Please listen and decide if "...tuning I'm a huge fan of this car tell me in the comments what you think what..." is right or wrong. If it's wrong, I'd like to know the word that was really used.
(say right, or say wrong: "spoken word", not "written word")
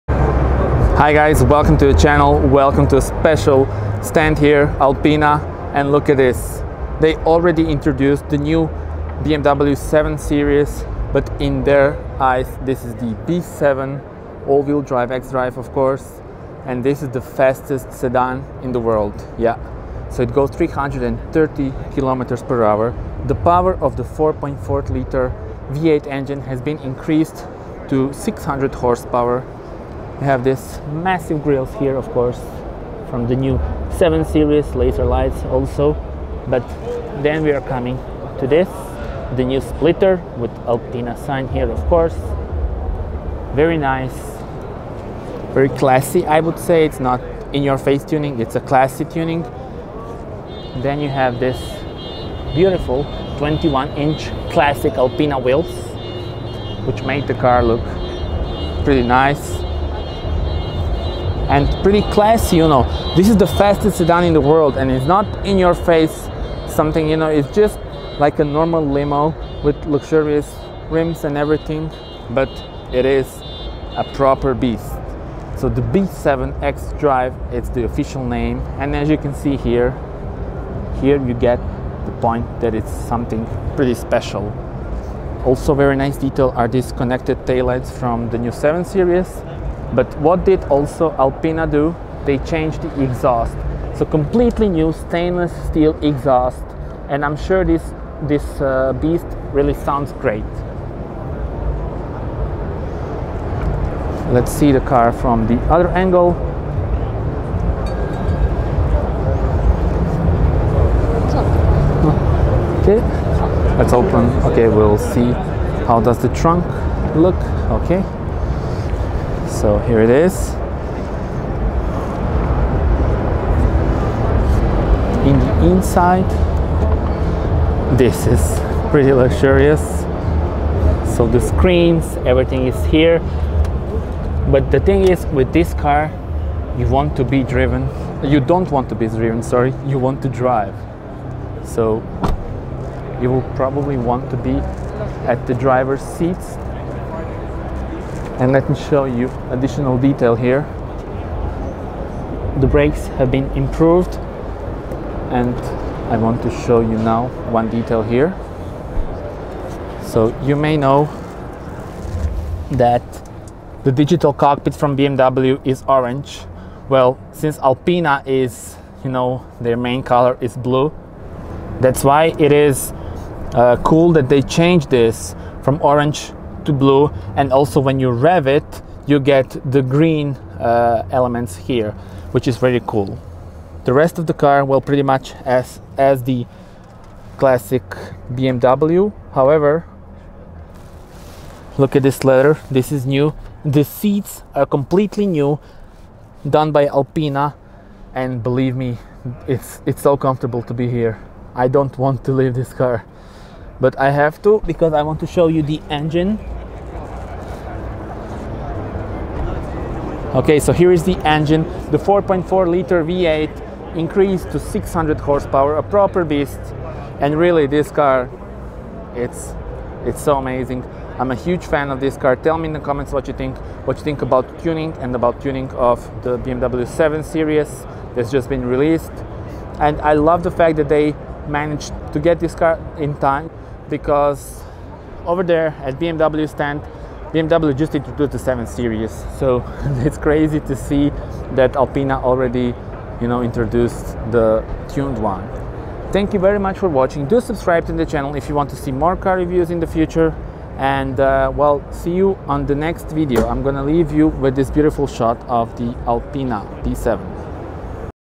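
wrong: "amazing", not "tuning".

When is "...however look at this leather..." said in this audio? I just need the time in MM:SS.
03:09.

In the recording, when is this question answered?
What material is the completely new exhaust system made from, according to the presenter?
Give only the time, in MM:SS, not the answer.
01:34.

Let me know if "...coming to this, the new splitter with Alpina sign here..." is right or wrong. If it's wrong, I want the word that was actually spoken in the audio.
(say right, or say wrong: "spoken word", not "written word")
right.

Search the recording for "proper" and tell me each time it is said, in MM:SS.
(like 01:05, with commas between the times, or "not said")
01:14, 03:35.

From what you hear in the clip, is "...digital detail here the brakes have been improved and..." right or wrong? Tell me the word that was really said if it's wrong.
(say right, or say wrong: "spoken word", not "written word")
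wrong: "additional", not "digital".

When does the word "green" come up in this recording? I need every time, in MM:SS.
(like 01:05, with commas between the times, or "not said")
02:59.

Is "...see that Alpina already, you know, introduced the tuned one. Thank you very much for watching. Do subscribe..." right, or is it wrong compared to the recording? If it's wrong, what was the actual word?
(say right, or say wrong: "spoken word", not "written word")
right.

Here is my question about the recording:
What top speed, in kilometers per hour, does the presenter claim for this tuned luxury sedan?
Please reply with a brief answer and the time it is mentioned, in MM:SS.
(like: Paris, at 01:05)
330, at 00:20.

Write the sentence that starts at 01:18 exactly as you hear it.
And as you can see here, here you get the point that it's something pretty special.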